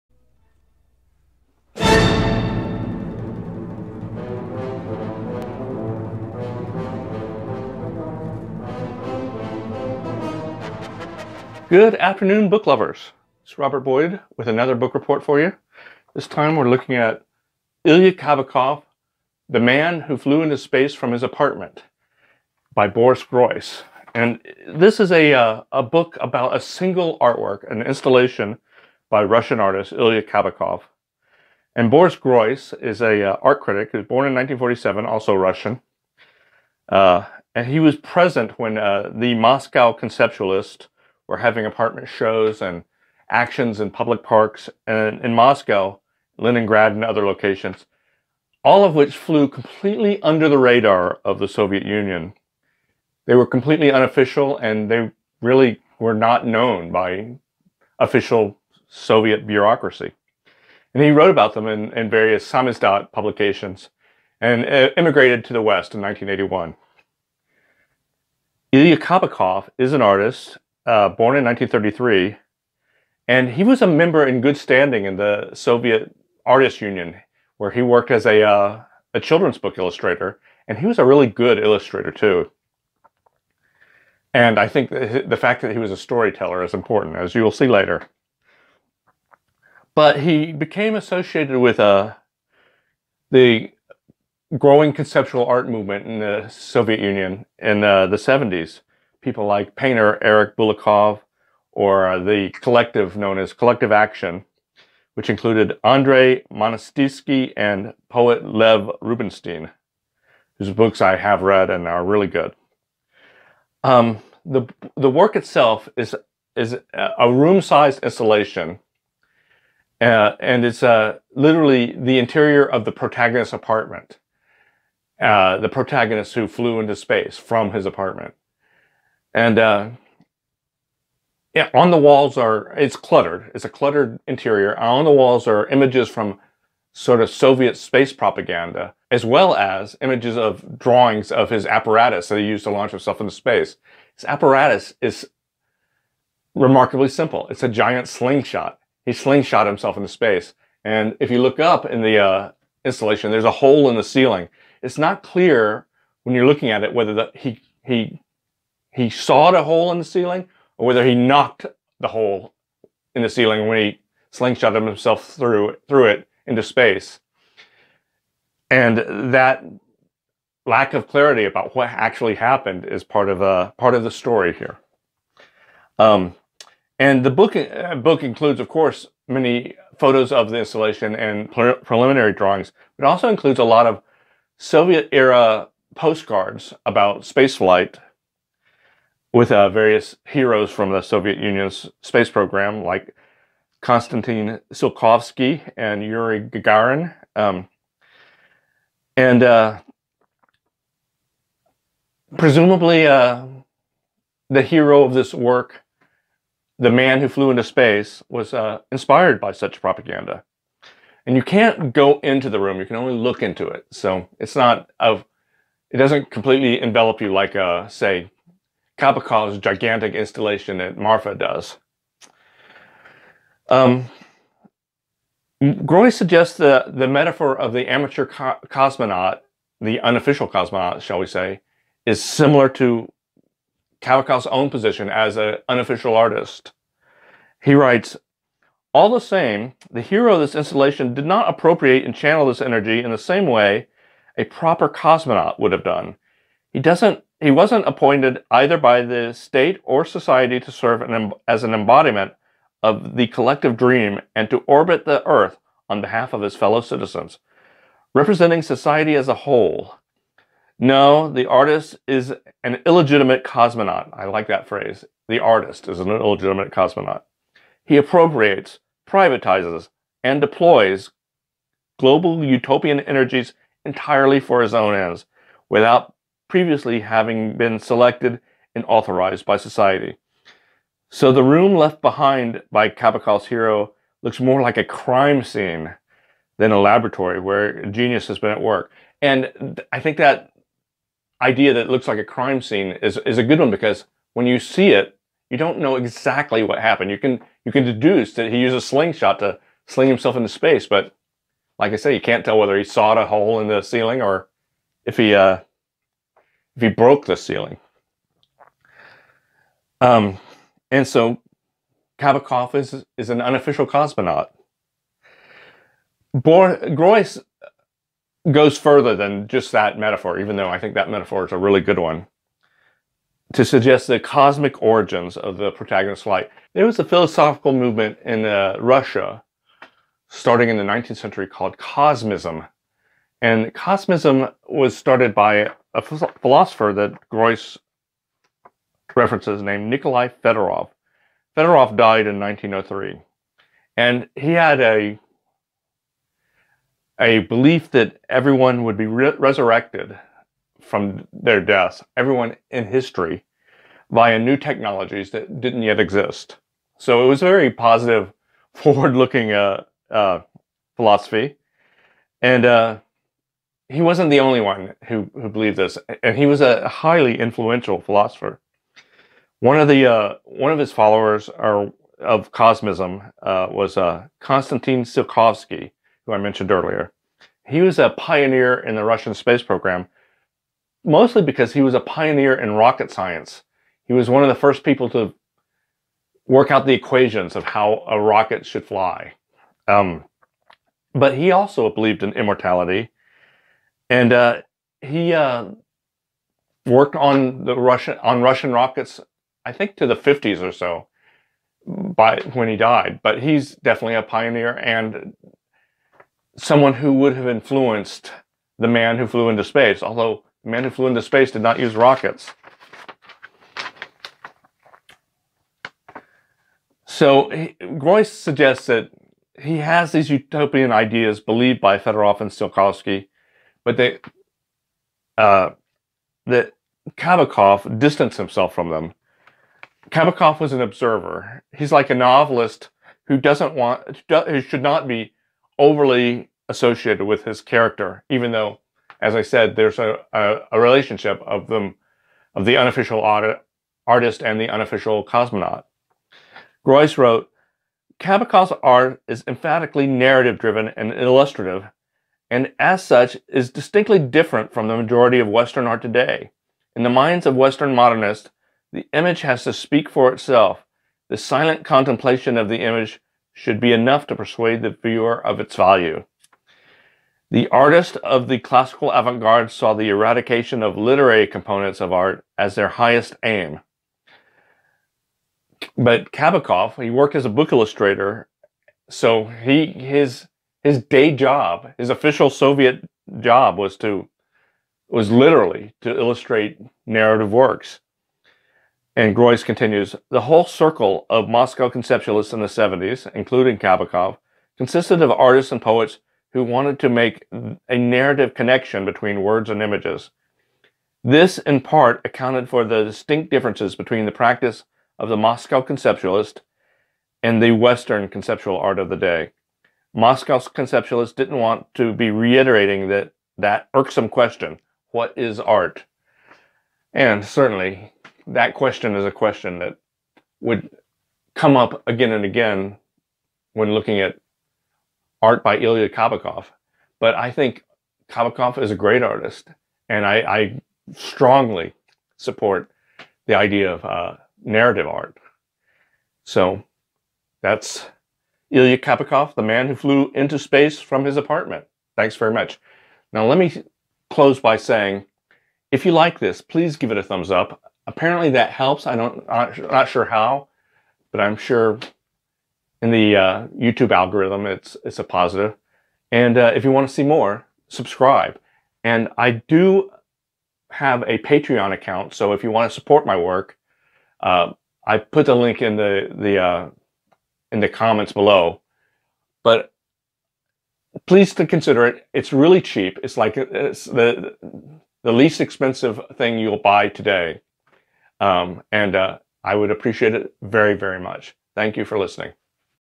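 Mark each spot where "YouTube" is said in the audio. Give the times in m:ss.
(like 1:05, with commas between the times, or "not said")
9:13.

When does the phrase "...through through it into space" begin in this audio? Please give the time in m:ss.
2:45.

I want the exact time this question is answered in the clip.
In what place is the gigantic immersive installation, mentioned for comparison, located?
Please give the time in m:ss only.
3:40.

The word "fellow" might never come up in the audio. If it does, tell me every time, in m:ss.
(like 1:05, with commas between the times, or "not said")
4:16.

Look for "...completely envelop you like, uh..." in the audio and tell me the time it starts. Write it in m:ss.
3:36.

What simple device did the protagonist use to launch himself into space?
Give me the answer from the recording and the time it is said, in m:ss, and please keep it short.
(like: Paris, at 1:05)
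A giant slingshot, at 2:27.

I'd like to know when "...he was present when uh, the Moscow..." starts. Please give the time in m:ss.
0:37.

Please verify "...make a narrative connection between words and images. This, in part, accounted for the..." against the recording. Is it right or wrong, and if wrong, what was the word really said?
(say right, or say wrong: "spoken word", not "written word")
right.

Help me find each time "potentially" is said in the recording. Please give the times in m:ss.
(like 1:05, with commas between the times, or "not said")
not said.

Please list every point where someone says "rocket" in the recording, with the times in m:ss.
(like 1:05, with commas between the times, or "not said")
6:22, 6:28, 6:38, 6:51.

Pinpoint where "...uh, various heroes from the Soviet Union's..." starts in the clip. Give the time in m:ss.
3:09.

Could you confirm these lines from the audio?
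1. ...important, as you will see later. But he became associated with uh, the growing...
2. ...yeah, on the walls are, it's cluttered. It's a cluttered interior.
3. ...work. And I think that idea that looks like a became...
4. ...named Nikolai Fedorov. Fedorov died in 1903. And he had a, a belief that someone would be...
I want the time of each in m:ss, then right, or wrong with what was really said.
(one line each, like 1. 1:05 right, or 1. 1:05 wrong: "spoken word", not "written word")
1. 1:26 right
2. 2:11 right
3. 4:48 wrong: "crime", not "became"
4. 5:39 wrong: "everyone", not "someone".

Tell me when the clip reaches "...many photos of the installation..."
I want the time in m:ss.
2:59.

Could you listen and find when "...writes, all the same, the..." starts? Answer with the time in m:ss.
3:57.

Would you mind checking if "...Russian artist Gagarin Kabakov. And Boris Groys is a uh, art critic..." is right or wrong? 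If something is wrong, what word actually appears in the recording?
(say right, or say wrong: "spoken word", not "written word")
wrong: "Ilya", not "Gagarin".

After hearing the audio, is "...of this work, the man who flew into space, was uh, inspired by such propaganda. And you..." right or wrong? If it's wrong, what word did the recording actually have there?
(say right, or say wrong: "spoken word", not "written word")
right.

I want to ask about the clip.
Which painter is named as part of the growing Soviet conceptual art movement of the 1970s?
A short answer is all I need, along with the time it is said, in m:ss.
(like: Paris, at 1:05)
Eric Bulatov, at 1:40.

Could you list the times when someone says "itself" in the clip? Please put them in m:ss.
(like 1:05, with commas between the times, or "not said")
1:55, 7:40.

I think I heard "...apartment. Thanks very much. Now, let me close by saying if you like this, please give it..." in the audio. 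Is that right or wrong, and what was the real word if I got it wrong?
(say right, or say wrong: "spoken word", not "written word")
right.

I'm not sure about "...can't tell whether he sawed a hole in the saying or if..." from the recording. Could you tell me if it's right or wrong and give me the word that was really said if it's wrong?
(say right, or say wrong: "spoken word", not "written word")
wrong: "ceiling", not "saying".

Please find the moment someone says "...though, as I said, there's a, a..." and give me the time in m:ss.
7:18.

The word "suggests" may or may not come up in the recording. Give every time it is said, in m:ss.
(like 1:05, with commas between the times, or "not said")
3:46, 5:23, 6:58.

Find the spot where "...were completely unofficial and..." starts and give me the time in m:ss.
0:53.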